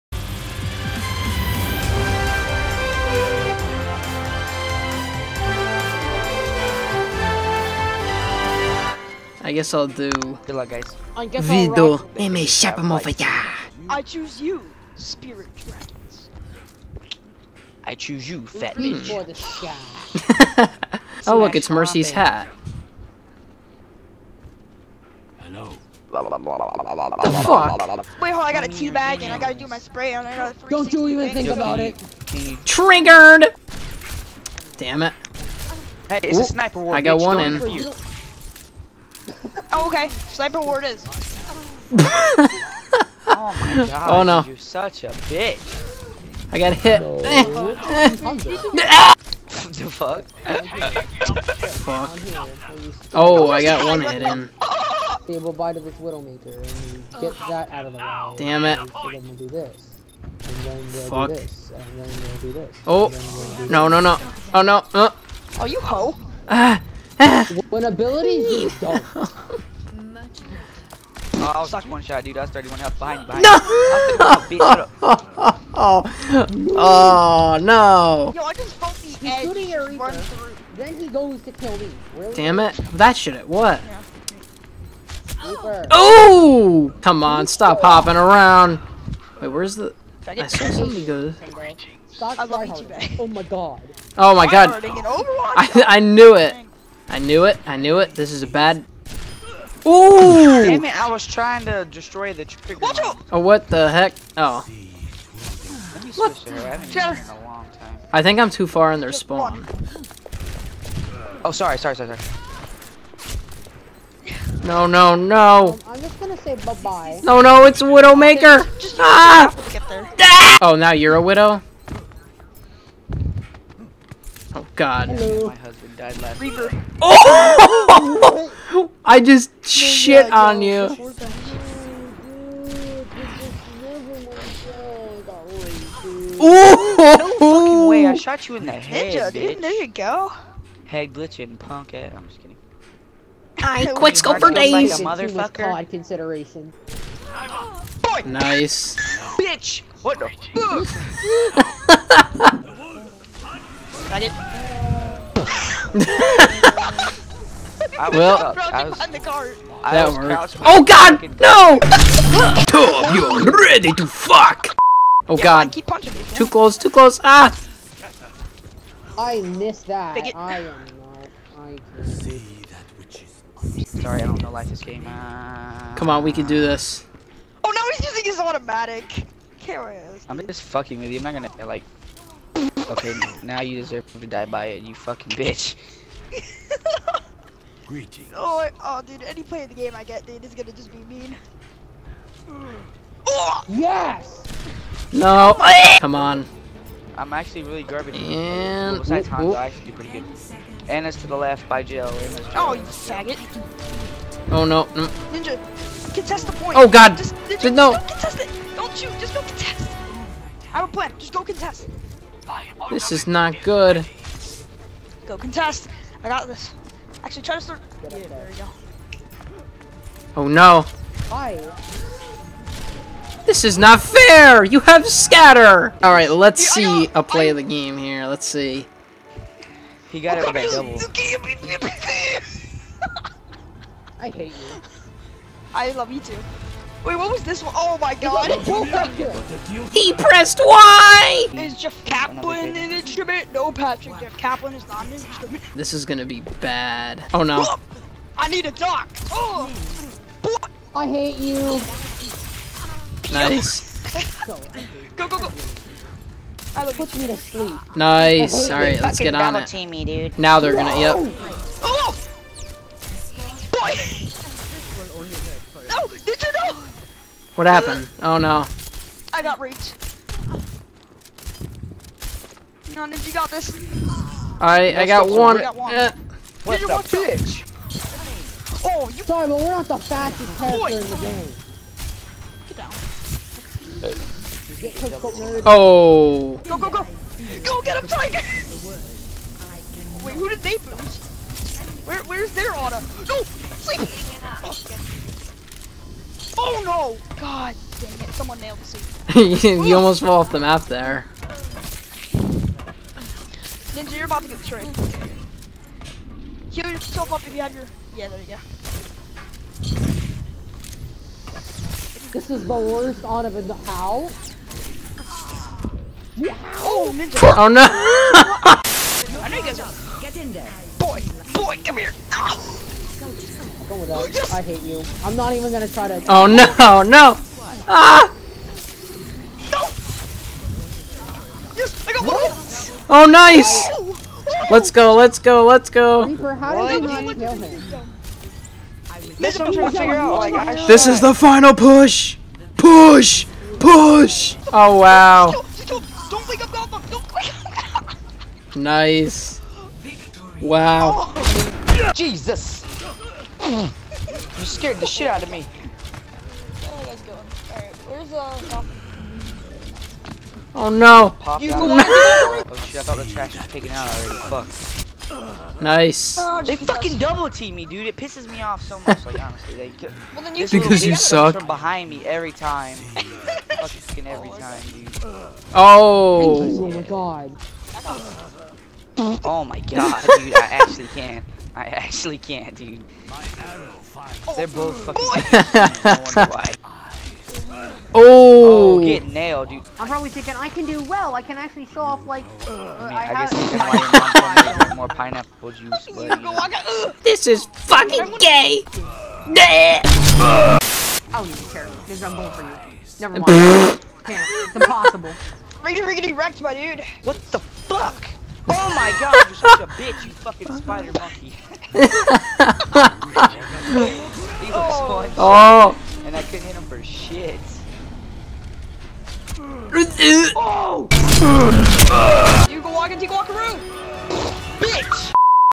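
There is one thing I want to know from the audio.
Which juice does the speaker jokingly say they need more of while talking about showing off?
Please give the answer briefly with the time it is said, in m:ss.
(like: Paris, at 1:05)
pineapple juice, at 6:35.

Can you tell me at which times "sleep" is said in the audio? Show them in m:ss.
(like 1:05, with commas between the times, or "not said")
4:17, 4:53.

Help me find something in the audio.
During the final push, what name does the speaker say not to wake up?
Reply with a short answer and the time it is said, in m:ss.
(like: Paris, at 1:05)
Alpha, at 5:46.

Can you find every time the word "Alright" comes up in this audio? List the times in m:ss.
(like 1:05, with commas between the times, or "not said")
3:46, 4:18.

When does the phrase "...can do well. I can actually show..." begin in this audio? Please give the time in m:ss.
6:30.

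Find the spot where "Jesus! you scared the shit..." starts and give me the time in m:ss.
5:52.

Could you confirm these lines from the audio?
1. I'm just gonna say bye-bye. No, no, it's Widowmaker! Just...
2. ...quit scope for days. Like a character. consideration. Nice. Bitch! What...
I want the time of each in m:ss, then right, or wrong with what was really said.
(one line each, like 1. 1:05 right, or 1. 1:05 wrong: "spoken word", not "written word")
1. 1:55 right
2. 2:23 wrong: "motherfucker", not "character".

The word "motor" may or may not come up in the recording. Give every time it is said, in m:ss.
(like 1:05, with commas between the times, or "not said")
not said.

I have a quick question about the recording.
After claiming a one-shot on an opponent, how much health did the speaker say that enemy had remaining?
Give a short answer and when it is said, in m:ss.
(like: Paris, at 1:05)
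31, at 1:12.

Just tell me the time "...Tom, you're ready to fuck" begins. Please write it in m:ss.
2:42.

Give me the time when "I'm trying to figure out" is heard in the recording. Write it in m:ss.
5:39.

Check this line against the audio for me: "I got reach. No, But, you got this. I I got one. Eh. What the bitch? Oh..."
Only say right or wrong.
wrong.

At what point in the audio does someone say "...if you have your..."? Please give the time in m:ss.
5:07.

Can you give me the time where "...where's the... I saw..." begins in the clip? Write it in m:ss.
1:29.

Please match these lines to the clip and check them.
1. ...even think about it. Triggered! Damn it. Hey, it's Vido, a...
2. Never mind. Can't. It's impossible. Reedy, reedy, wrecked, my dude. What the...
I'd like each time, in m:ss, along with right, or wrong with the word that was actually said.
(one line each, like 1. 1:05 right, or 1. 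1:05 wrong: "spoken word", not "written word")
1. 0:31 wrong: "Ooh", not "Vido"
2. 6:43 right.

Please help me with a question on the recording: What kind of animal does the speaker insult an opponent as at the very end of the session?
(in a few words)
spider monkey.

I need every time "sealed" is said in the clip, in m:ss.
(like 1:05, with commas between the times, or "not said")
not said.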